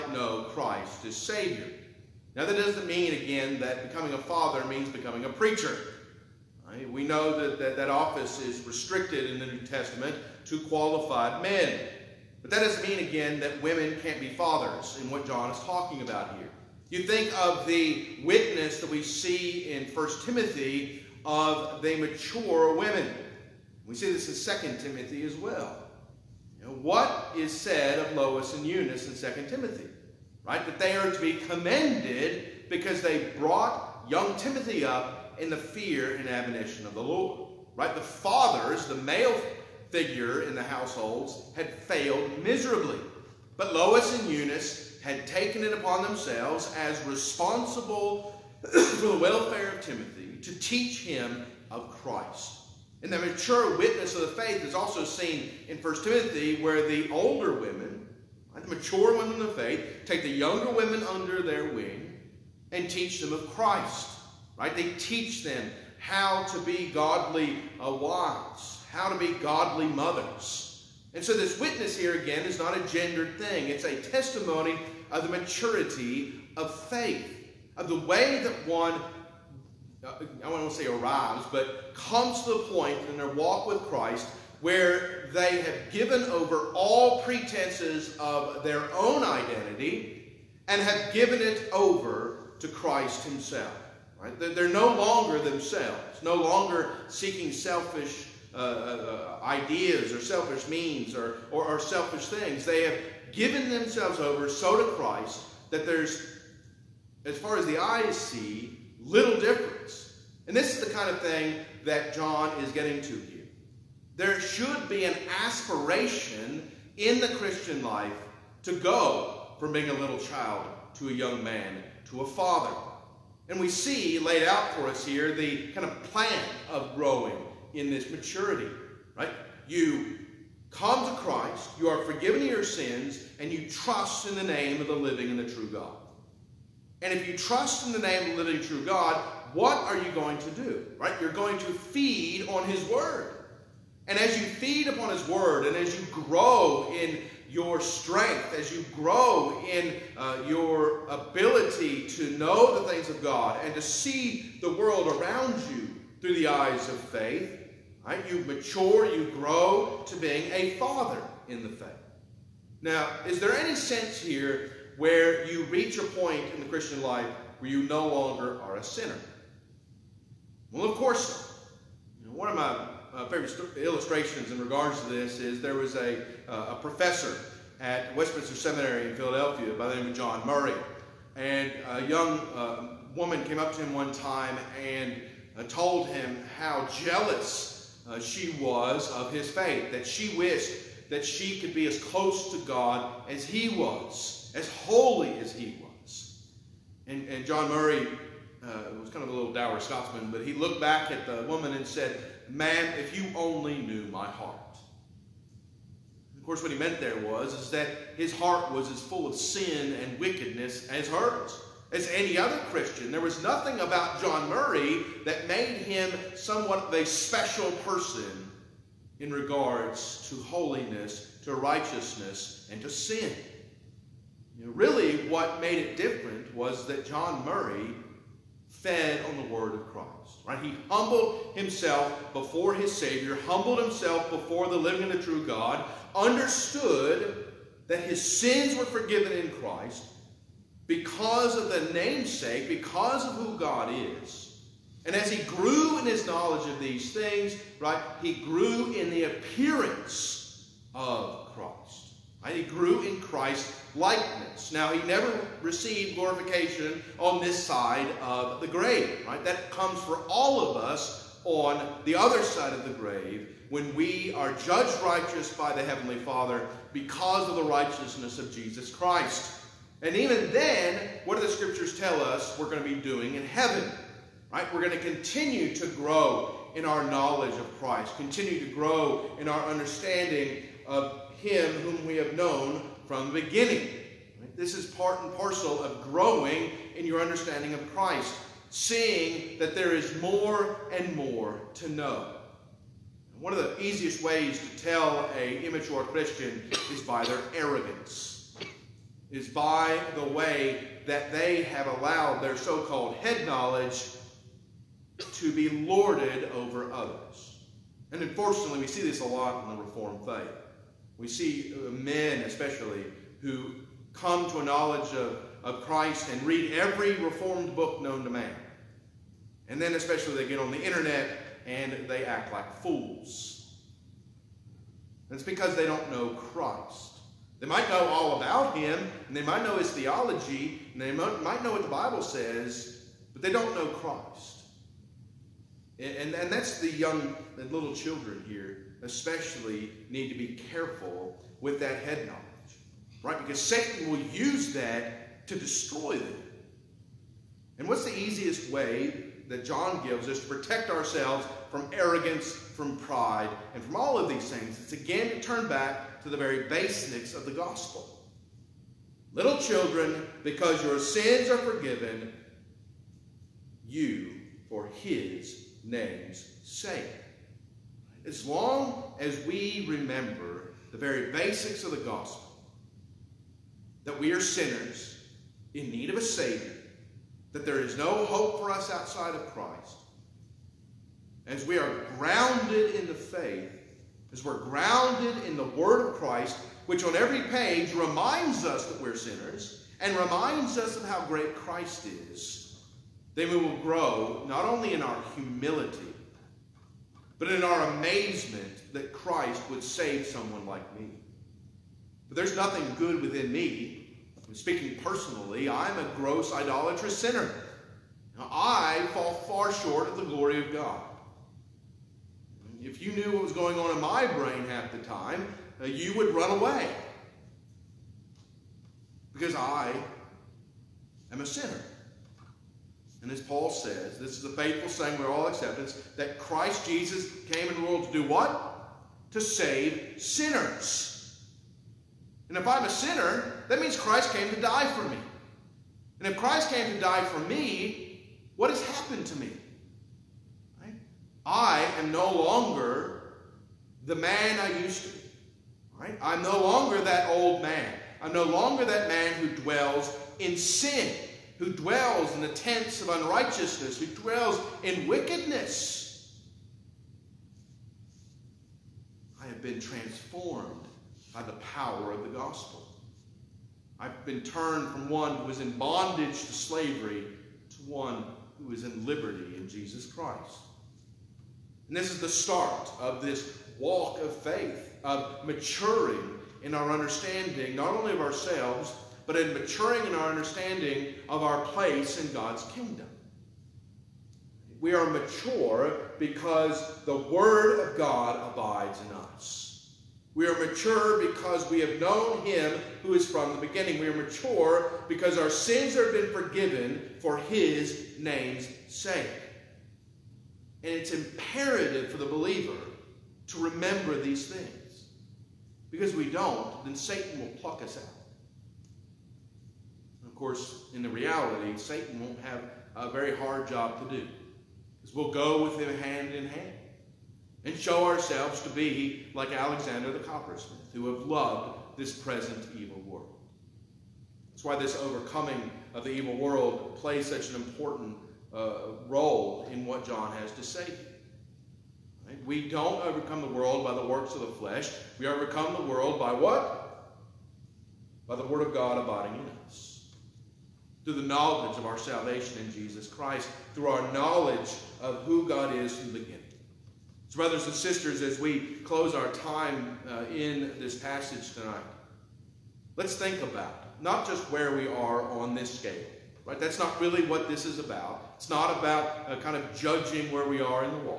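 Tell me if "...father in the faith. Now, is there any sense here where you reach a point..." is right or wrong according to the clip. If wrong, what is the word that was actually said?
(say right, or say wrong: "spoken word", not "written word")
right.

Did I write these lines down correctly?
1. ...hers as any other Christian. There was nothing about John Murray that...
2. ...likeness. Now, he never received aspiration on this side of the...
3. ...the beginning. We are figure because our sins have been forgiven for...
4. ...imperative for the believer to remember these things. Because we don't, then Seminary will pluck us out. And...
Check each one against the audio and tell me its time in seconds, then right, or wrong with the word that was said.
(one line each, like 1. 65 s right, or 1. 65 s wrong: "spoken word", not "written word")
1. 211 s right
2. 253 s wrong: "glorification", not "aspiration"
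3. 493 s wrong: "mature", not "figure"
4. 501 s wrong: "Satan", not "Seminary".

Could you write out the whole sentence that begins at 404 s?
And speaking personally, I'm a gross idolatrous sinner.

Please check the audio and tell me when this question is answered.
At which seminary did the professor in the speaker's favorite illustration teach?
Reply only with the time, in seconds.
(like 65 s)
178 s.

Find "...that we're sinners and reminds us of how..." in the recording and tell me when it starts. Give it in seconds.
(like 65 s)
388 s.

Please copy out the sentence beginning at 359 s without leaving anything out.
Little children, because your sins are forgiven, you for his name's sake.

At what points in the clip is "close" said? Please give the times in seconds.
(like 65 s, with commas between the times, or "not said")
192 s, 548 s.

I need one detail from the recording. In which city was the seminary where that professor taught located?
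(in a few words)
Philadelphia.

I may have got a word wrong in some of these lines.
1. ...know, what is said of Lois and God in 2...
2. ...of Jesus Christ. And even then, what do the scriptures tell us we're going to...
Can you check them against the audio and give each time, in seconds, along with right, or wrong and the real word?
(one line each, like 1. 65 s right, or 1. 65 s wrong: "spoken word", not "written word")
1. 26 s wrong: "Eunice", not "God"
2. 268 s right.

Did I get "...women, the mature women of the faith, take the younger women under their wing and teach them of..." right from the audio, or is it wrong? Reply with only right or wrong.
right.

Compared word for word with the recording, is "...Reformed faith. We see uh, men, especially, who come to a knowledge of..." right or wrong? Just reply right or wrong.
right.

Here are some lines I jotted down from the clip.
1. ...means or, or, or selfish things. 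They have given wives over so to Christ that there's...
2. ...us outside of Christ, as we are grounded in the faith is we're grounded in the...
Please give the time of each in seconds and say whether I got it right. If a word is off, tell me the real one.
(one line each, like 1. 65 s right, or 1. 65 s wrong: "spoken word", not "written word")
1. 100 s wrong: "themselves", not "wives"
2. 378 s right.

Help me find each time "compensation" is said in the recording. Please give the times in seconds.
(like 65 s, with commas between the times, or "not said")
not said.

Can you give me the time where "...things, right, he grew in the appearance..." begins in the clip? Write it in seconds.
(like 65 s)
247 s.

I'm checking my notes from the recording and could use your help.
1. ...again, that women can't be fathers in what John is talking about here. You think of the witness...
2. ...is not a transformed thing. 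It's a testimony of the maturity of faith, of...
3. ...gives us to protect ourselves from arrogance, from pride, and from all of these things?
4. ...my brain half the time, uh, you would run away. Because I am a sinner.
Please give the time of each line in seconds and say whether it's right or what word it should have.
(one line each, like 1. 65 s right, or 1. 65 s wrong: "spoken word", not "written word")
1. 13 s right
2. 72 s wrong: "gendered", not "transformed"
3. 350 s right
4. 414 s right.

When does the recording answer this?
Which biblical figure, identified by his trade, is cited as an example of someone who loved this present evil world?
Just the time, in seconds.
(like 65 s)
519 s.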